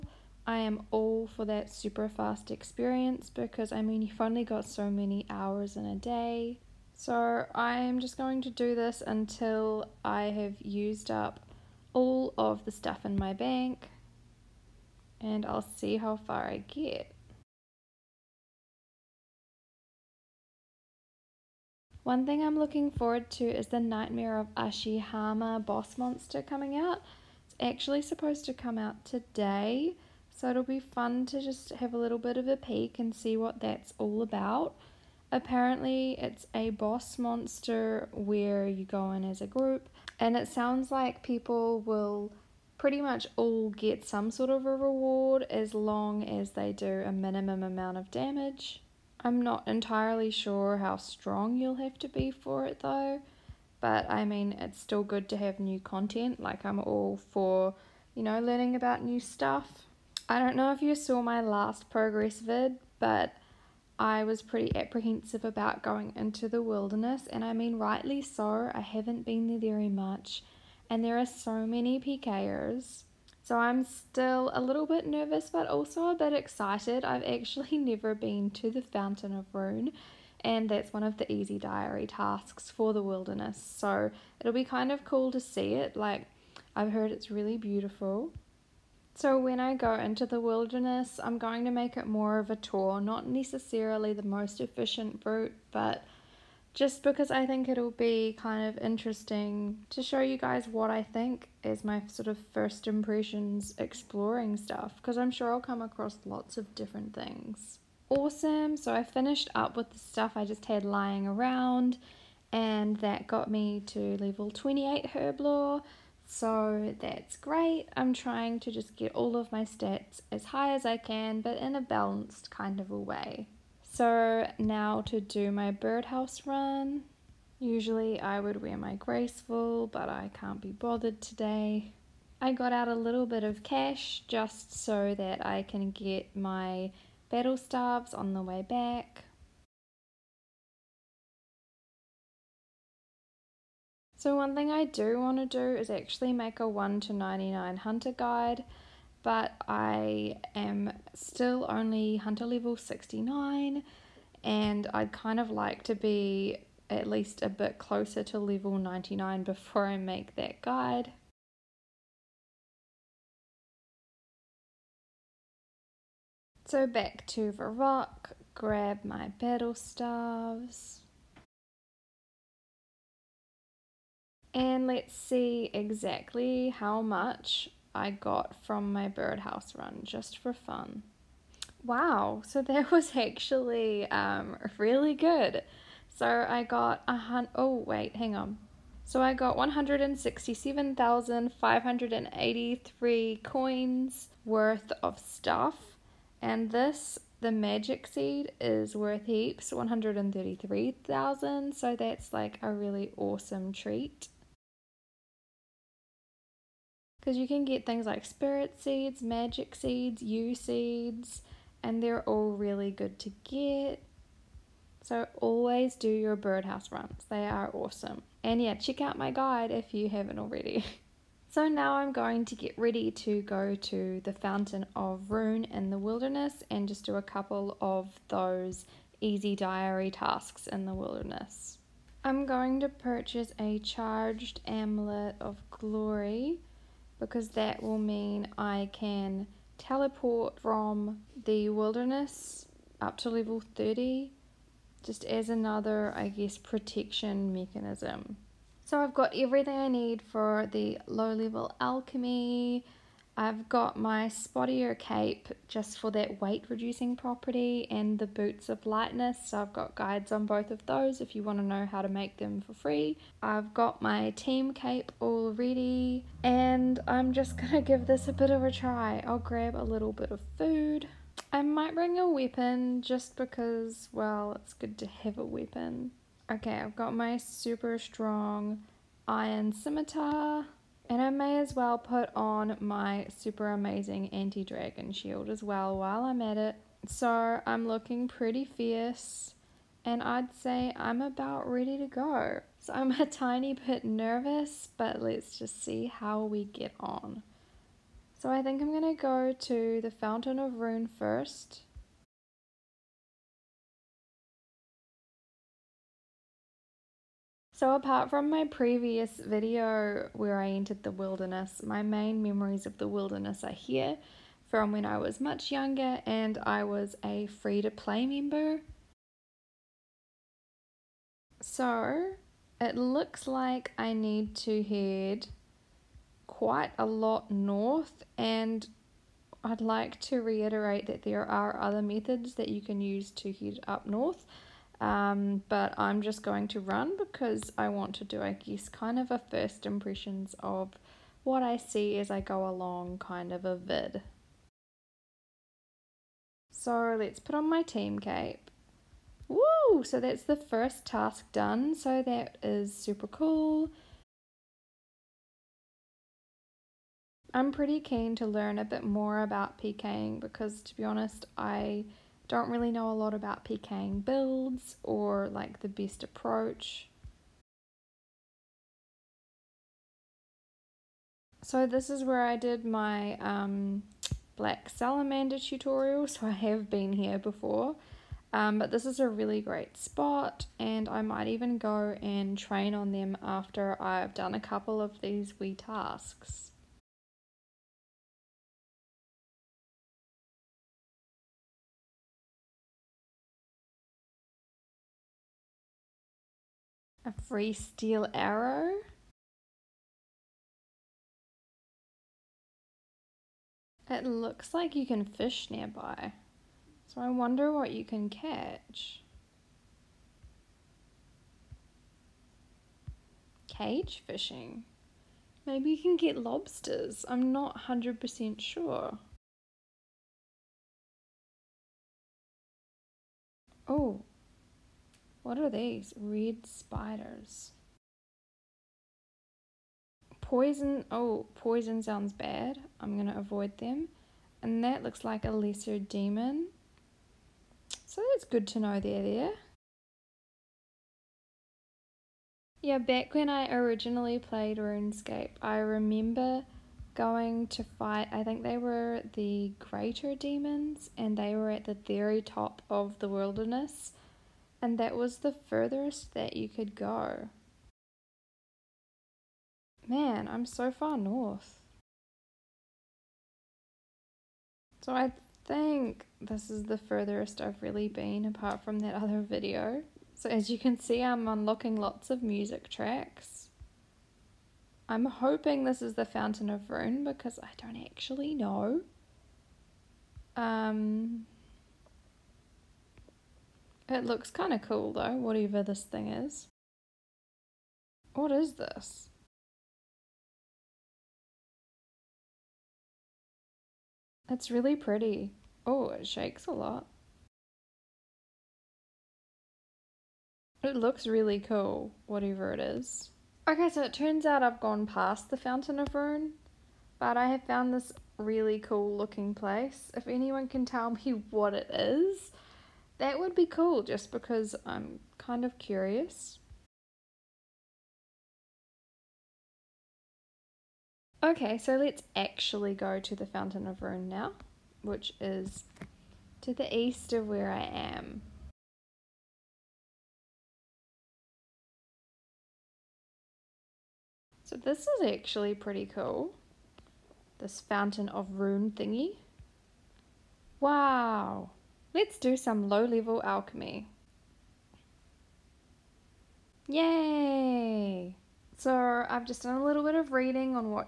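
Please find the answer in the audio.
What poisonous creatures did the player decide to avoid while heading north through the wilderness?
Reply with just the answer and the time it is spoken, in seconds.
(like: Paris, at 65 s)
Red spiders, at 426 s.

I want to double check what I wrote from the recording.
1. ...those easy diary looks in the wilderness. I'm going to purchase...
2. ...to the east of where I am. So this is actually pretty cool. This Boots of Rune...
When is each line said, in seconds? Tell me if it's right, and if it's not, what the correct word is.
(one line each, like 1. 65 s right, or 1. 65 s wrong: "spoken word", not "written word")
1. 228 s wrong: "tasks", not "looks"
2. 526 s wrong: "Fountain", not "Boots".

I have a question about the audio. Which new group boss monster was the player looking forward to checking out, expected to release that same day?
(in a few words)
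Nightmare of Ashihama.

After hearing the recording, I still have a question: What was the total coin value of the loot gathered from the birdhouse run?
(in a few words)
167,583 coins.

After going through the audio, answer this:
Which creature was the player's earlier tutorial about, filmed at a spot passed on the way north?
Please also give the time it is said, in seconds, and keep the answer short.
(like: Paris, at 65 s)
Black salamander, at 374 s.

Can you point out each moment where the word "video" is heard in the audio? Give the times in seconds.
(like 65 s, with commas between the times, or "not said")
309 s, 469 s.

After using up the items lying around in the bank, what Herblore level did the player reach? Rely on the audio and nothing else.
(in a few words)
28.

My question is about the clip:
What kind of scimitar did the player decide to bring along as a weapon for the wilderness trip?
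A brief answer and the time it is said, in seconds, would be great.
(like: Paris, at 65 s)
Iron scimitar, at 279 s.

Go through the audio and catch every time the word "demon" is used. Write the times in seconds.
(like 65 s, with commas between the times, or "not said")
435 s, 450 s.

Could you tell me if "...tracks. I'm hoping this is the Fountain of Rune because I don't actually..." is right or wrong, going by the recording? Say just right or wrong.
right.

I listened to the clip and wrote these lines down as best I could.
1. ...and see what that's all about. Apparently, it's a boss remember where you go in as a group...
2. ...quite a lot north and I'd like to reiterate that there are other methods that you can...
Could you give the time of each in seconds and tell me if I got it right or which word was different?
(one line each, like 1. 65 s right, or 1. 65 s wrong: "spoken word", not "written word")
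1. 32 s wrong: "monster", not "remember"
2. 326 s right.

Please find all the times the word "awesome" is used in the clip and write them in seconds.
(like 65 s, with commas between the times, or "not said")
108 s, 203 s, 217 s.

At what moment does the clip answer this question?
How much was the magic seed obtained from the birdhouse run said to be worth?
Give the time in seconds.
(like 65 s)
199 s.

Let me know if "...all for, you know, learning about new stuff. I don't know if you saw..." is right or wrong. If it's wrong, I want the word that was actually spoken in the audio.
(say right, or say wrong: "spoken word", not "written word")
right.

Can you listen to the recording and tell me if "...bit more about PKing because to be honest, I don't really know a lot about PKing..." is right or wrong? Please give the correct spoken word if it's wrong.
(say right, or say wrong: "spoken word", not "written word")
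right.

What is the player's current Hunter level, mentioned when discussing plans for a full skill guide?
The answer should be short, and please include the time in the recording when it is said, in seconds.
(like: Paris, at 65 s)
69, at 152 s.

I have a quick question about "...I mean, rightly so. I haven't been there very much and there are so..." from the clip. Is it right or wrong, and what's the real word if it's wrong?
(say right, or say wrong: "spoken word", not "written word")
right.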